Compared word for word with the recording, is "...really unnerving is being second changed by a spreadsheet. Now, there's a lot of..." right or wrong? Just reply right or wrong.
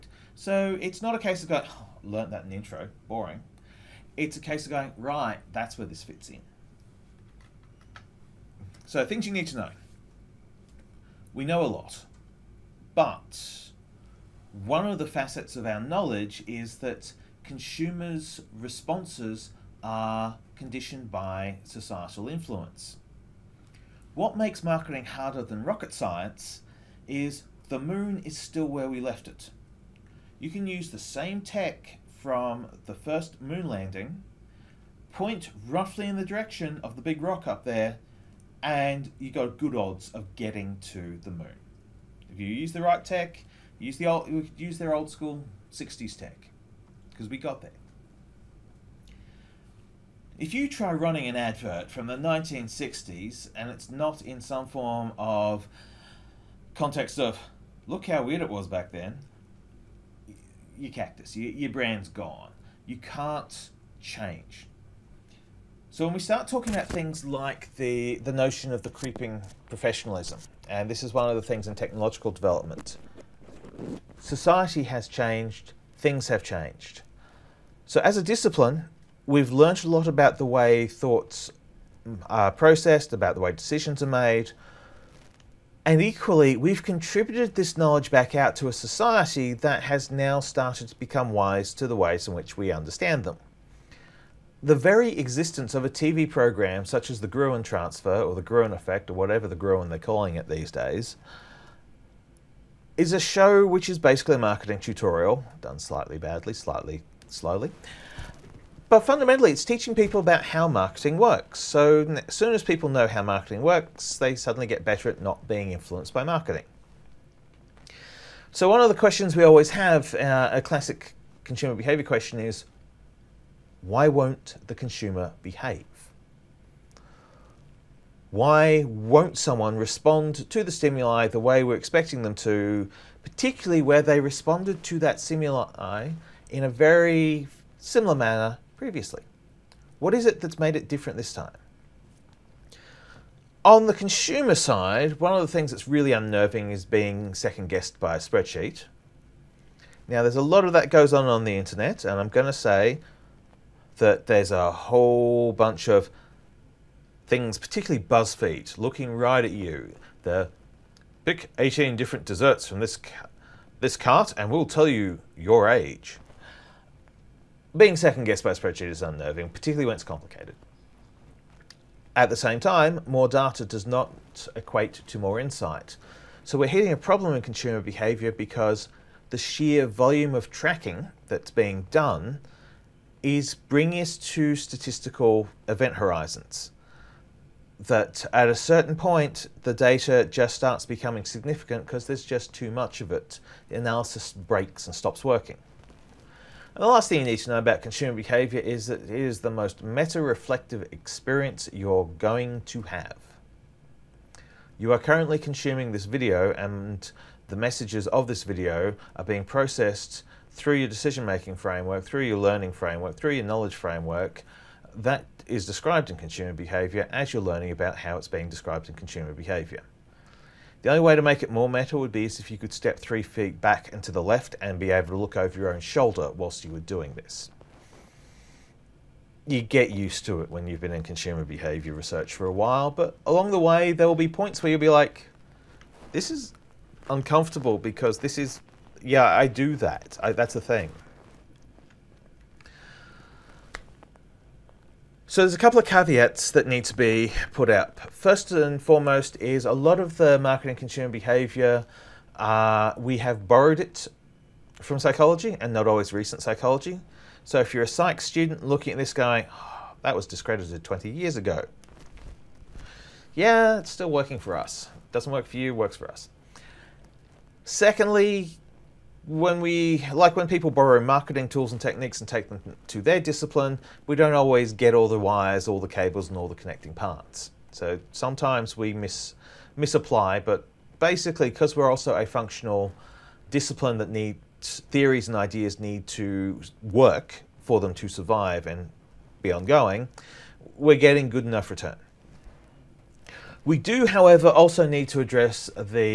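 wrong.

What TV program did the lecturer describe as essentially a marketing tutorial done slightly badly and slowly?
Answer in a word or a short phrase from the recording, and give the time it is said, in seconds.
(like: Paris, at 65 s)
The Gruen Transfer, at 97 s.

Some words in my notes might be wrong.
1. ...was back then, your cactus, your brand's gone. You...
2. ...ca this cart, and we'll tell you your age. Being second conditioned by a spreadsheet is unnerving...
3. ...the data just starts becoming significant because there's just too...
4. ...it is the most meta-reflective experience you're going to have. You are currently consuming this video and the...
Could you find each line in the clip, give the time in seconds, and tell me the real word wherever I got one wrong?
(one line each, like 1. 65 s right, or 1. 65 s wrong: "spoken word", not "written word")
1. 58 s right
2. 162 s wrong: "guessed", not "conditioned"
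3. 189 s right
4. 199 s right.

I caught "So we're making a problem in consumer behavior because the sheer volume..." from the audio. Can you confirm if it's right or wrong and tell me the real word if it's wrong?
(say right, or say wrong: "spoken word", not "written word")
wrong: "hitting", not "making".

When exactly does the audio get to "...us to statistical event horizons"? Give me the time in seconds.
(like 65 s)
183 s.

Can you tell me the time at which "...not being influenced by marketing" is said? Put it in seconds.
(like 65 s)
115 s.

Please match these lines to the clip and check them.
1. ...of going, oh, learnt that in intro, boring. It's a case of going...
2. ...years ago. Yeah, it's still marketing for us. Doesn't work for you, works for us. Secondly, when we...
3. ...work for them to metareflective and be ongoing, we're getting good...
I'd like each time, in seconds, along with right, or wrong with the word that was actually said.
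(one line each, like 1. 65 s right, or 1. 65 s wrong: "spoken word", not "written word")
1. 1 s right
2. 261 s wrong: "working", not "marketing"
3. 286 s wrong: "survive", not "metareflective".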